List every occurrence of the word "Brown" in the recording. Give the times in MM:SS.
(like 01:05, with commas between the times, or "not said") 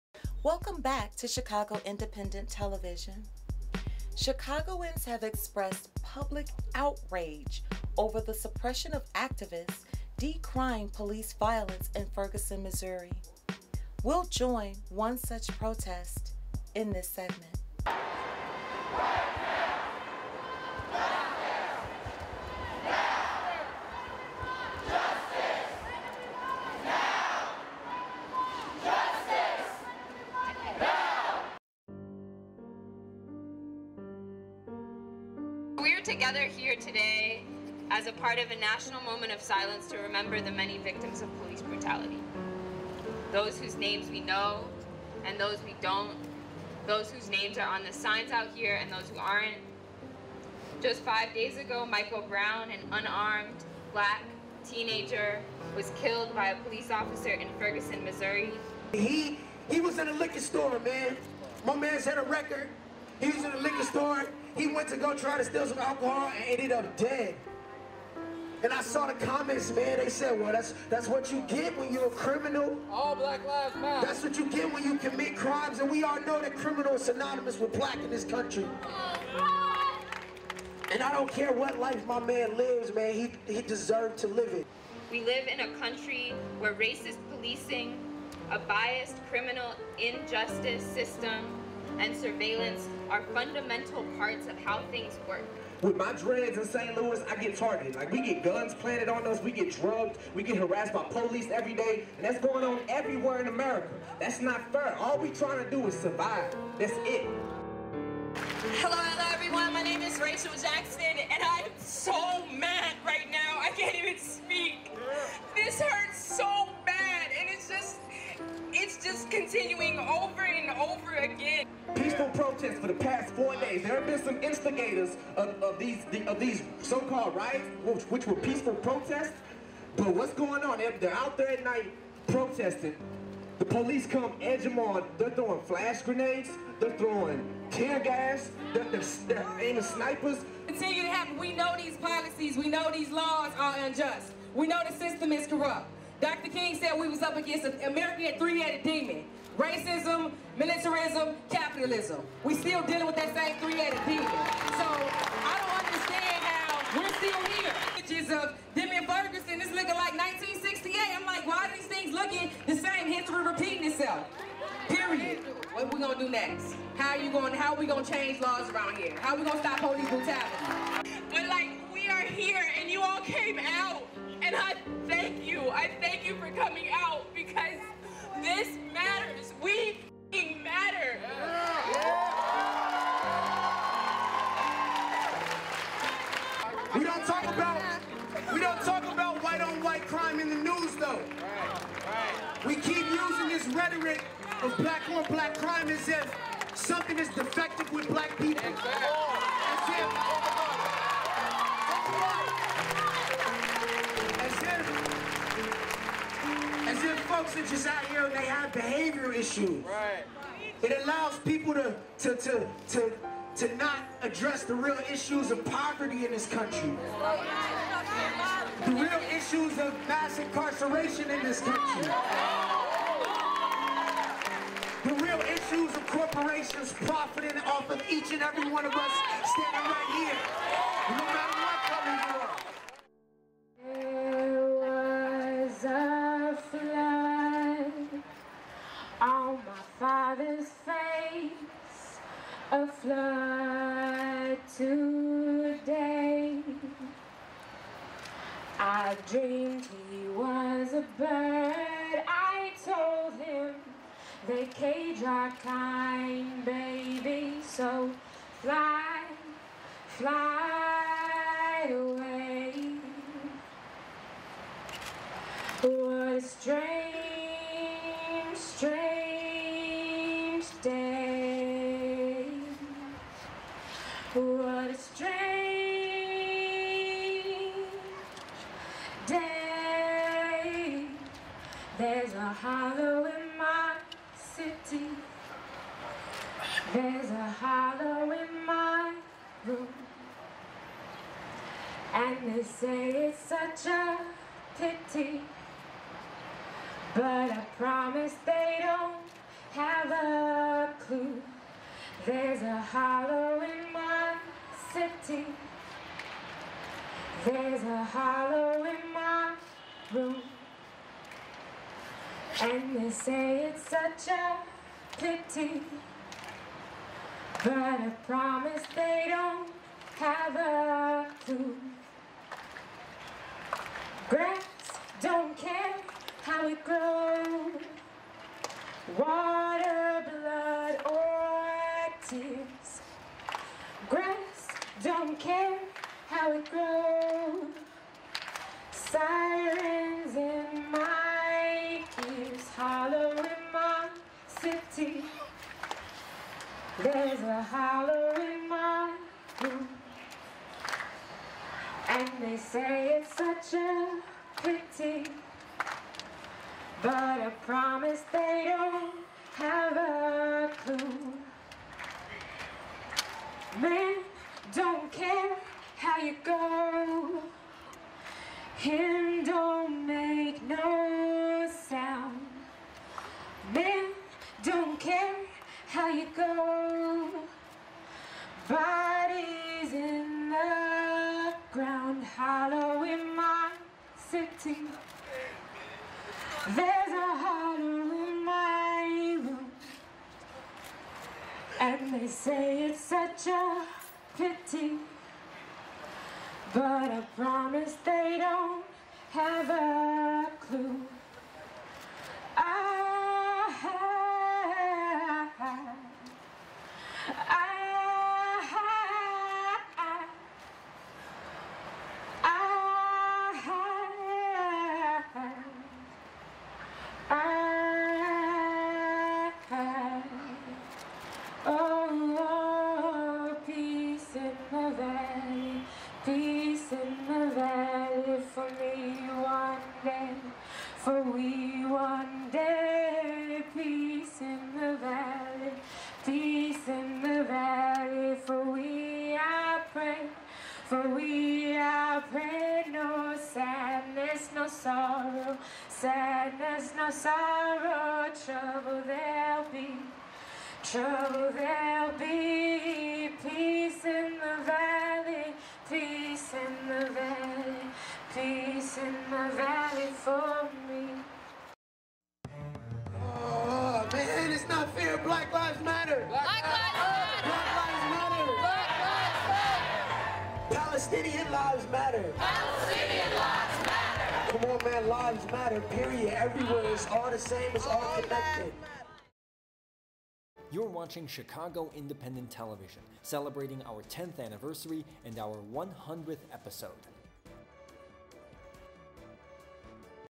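00:52.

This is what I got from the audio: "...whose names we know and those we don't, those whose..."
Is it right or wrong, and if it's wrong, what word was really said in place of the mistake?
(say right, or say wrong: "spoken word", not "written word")
right.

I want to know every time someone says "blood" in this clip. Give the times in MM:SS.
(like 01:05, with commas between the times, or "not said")
05:30.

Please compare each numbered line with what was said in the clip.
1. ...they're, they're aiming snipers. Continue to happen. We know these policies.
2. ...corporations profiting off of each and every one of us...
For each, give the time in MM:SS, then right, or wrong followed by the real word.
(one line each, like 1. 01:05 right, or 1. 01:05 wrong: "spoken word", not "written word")
1. 02:18 right
2. 03:46 right.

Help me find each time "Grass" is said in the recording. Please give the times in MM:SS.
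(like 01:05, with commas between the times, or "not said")
05:24, 05:34.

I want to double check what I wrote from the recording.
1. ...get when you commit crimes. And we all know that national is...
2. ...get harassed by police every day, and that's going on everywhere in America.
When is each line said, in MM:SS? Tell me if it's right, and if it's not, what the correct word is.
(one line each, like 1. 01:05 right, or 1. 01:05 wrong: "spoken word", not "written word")
1. 01:14 wrong: "criminal", not "national"
2. 01:40 right.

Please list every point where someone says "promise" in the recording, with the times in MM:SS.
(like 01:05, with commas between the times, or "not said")
04:57, 05:18, 05:57, 06:37.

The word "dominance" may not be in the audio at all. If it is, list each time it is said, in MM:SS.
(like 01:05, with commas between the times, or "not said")
not said.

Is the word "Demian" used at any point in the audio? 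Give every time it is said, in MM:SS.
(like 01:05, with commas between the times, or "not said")
02:38.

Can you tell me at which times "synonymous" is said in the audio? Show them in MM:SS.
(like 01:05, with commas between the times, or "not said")
01:17.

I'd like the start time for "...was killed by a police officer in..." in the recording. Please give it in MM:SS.
00:55.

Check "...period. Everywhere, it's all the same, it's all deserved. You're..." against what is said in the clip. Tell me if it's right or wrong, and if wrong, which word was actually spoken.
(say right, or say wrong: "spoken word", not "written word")
wrong: "connected", not "deserved".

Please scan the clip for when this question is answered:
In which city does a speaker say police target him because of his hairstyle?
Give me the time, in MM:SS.
01:36.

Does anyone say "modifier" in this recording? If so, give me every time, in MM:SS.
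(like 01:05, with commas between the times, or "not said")
not said.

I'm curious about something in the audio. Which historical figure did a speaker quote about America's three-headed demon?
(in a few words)
Dr. King.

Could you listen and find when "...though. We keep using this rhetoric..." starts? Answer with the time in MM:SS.
03:10.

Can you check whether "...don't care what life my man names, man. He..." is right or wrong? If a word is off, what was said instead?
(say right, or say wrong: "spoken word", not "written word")
wrong: "lives", not "names".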